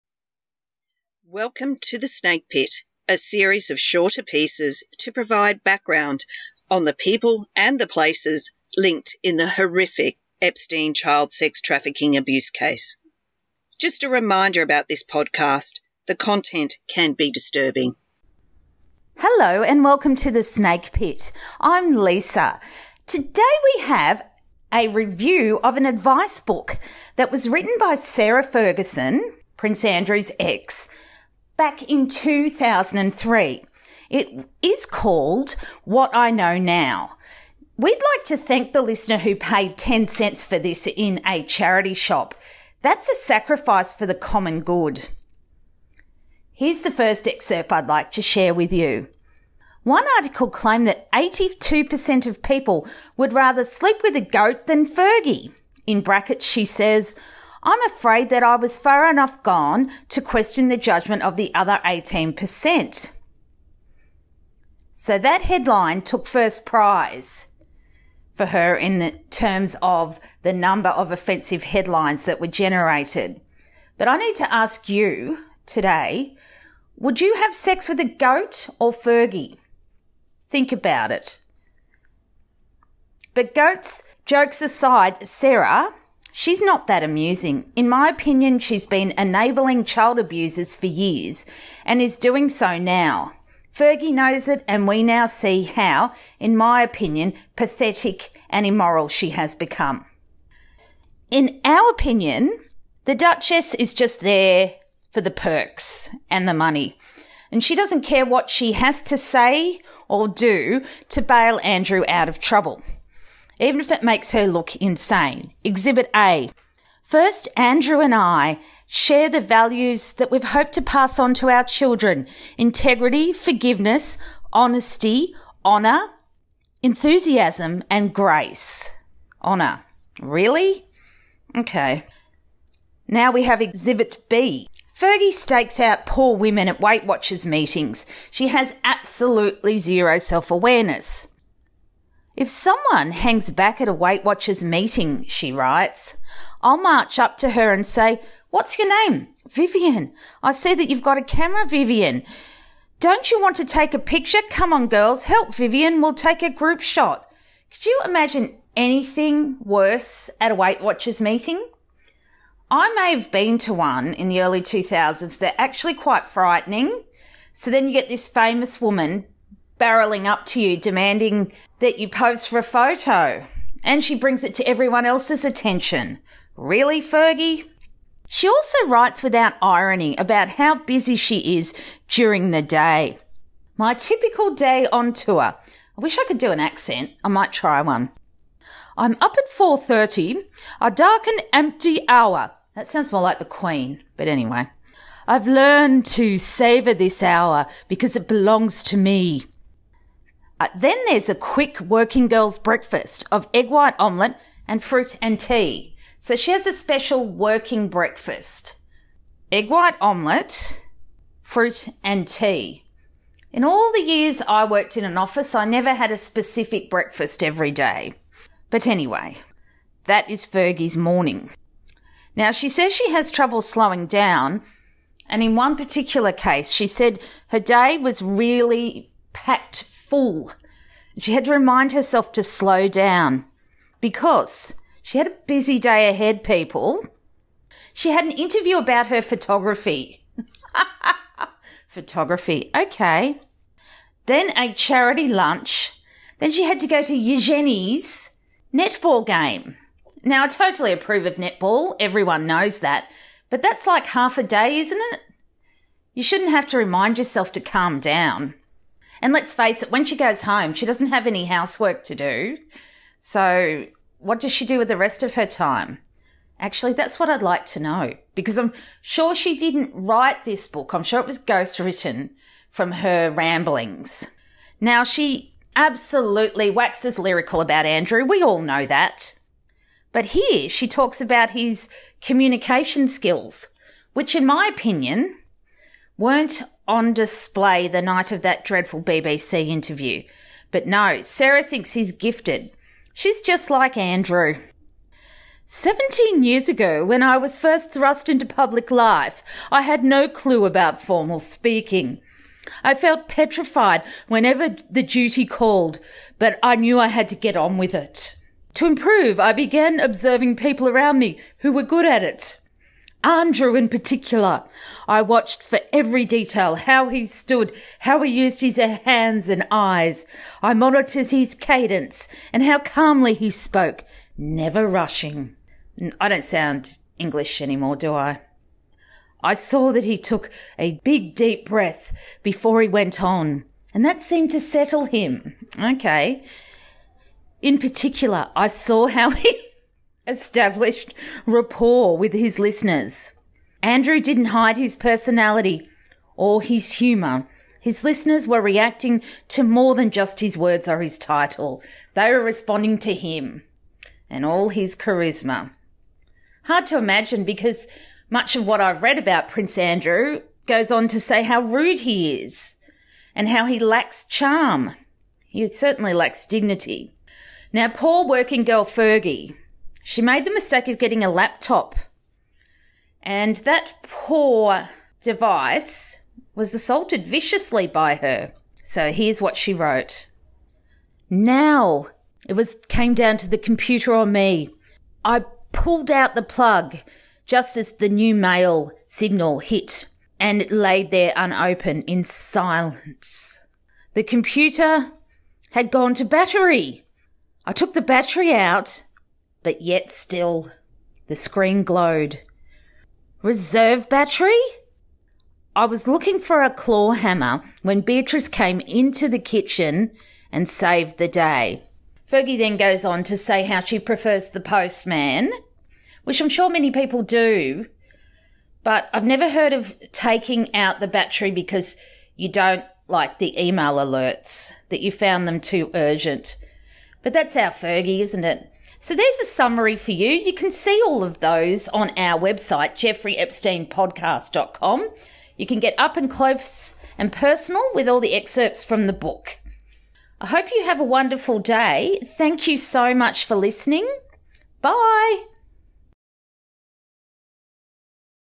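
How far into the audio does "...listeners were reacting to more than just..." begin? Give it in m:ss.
5:48.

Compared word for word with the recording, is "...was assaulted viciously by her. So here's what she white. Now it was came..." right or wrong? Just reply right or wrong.
wrong.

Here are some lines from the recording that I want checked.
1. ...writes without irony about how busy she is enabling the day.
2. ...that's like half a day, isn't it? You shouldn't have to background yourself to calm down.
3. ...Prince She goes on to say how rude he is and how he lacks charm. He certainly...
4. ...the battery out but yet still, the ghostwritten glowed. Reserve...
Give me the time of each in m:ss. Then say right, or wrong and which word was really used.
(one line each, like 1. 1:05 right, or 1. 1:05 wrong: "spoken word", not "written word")
1. 2:58 wrong: "during", not "enabling"
2. 4:13 wrong: "remind", not "background"
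3. 5:59 wrong: "Andrew", not "She"
4. 6:37 wrong: "screen", not "ghostwritten".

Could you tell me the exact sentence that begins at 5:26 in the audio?
I don't sound English anymore, do I?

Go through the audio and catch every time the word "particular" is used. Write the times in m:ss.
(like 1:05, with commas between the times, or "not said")
3:45, 5:13, 5:37.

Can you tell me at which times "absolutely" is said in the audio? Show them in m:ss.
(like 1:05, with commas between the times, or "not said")
2:18, 4:35.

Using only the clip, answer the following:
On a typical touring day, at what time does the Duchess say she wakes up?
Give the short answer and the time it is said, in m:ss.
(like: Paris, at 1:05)
4:30, at 3:09.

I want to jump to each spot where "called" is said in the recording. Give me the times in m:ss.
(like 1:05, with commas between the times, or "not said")
0:34, 5:05.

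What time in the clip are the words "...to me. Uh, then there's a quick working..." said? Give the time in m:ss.
3:18.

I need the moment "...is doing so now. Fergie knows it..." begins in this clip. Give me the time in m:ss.
1:32.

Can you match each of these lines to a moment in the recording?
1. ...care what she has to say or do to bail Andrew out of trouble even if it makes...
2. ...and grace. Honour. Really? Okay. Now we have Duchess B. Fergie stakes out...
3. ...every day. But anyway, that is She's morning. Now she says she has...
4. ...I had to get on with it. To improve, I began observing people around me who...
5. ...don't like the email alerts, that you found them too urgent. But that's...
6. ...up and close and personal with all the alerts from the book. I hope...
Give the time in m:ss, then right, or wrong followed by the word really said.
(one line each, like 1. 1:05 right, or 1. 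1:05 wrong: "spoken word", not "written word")
1. 1:48 right
2. 2:07 wrong: "Exhibit", not "Duchess"
3. 3:37 wrong: "Fergie", not "She"
4. 5:06 right
5. 7:02 right
6. 7:15 wrong: "excerpts", not "alerts".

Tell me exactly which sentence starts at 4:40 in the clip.
But here she talks about his communication skills, which, in my opinion, weren't on display the night of that dreadful BBC interview.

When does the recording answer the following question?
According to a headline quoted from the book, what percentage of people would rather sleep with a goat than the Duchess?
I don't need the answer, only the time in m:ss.
0:51.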